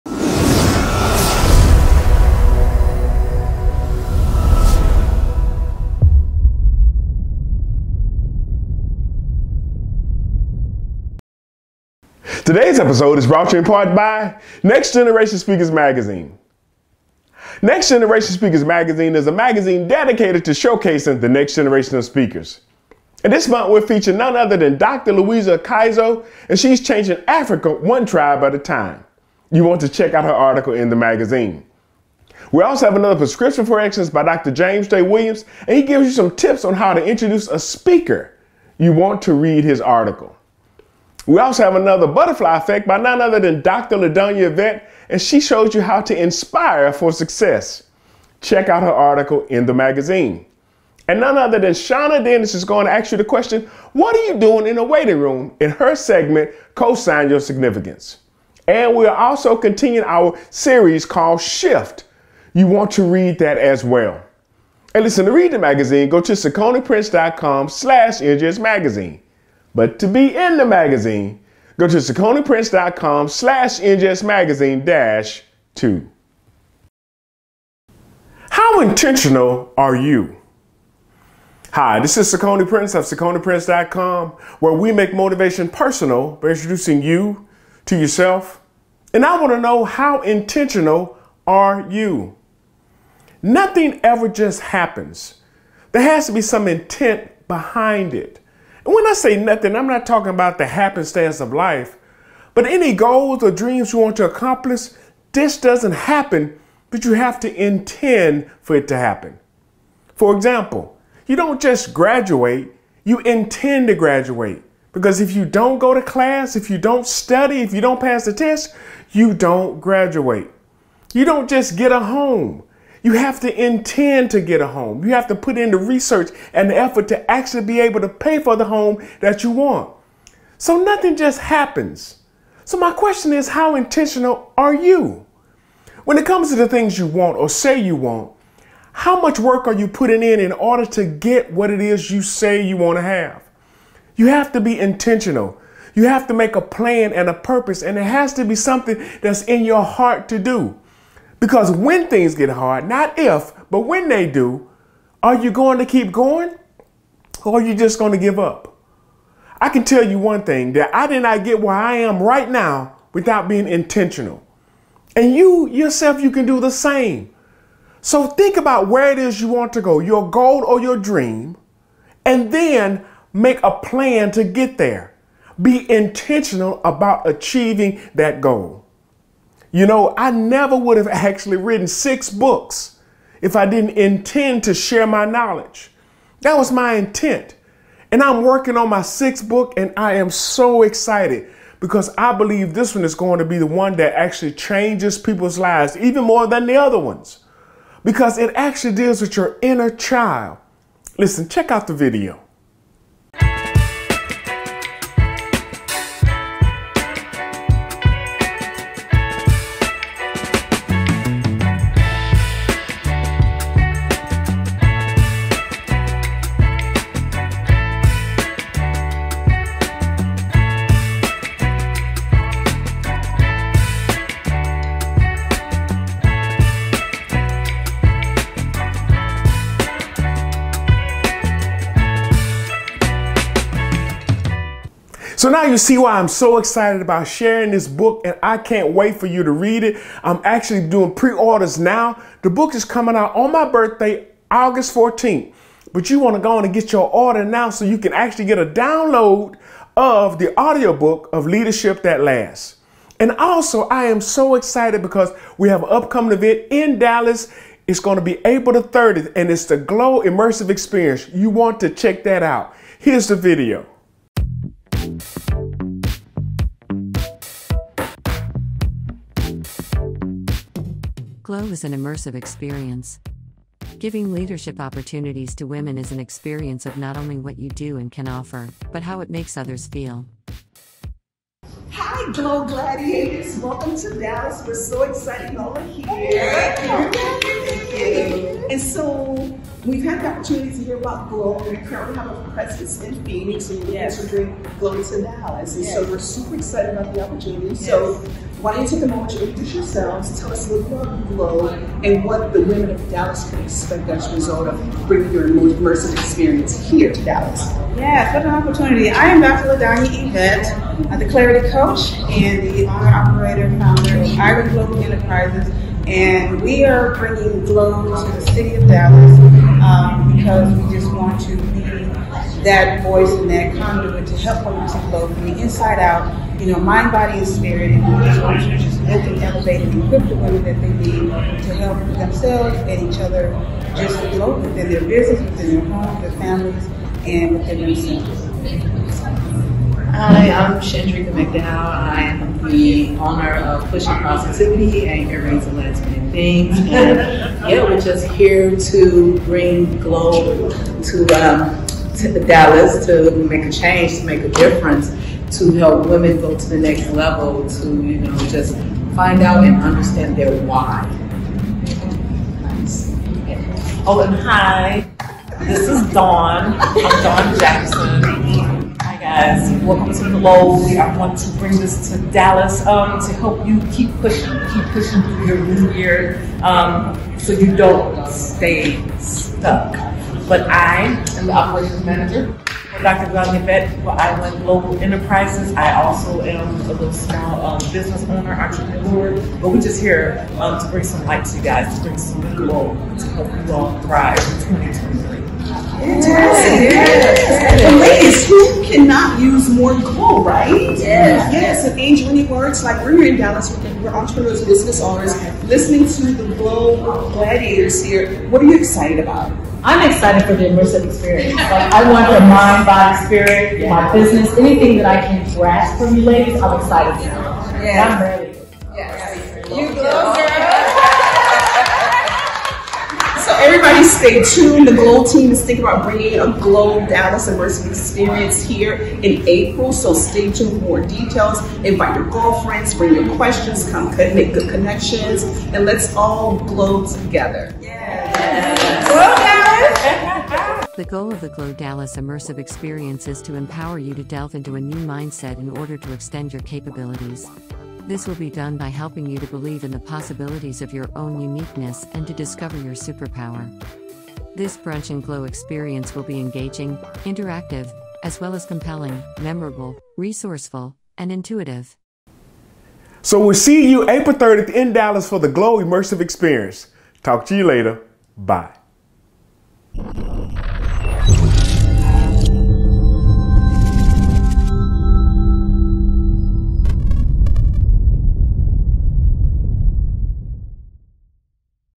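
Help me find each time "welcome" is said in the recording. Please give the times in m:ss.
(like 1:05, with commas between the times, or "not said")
4:43, 6:09.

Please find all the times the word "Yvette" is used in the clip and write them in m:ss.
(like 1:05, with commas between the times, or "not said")
0:44.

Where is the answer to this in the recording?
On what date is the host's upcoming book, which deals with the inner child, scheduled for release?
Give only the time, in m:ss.
4:04.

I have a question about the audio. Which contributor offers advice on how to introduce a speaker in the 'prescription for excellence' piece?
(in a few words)
Dr. James J. Williams.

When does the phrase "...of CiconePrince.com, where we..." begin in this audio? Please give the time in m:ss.
1:22.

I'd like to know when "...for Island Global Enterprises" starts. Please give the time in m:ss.
6:24.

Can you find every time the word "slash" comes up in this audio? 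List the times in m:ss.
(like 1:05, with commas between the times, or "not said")
1:07, 1:13.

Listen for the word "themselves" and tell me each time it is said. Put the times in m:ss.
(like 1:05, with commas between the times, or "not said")
5:32, 5:37.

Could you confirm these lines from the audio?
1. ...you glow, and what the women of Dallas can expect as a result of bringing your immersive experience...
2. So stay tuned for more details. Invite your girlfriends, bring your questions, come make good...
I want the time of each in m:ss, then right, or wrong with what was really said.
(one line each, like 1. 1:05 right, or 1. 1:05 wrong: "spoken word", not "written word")
1. 5:01 right
2. 7:09 right.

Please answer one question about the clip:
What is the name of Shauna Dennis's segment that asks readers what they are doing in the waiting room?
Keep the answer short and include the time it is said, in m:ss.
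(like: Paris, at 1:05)
Cosign Your Significance, at 0:56.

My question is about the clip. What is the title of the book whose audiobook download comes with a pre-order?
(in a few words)
Leadership That Lasts.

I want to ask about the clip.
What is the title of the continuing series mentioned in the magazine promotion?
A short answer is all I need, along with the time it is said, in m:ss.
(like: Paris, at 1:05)
Shift, at 1:01.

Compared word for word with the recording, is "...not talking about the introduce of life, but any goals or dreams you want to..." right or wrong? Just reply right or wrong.
wrong.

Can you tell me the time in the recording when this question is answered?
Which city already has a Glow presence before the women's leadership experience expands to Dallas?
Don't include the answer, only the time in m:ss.
4:53.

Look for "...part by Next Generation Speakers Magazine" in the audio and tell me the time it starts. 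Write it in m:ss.
0:13.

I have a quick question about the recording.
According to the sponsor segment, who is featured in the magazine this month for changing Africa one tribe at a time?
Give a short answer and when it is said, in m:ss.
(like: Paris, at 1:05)
Dr. Louisa Kaizo, at 0:24.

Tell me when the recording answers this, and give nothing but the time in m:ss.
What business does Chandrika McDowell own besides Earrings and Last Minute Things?
5:43.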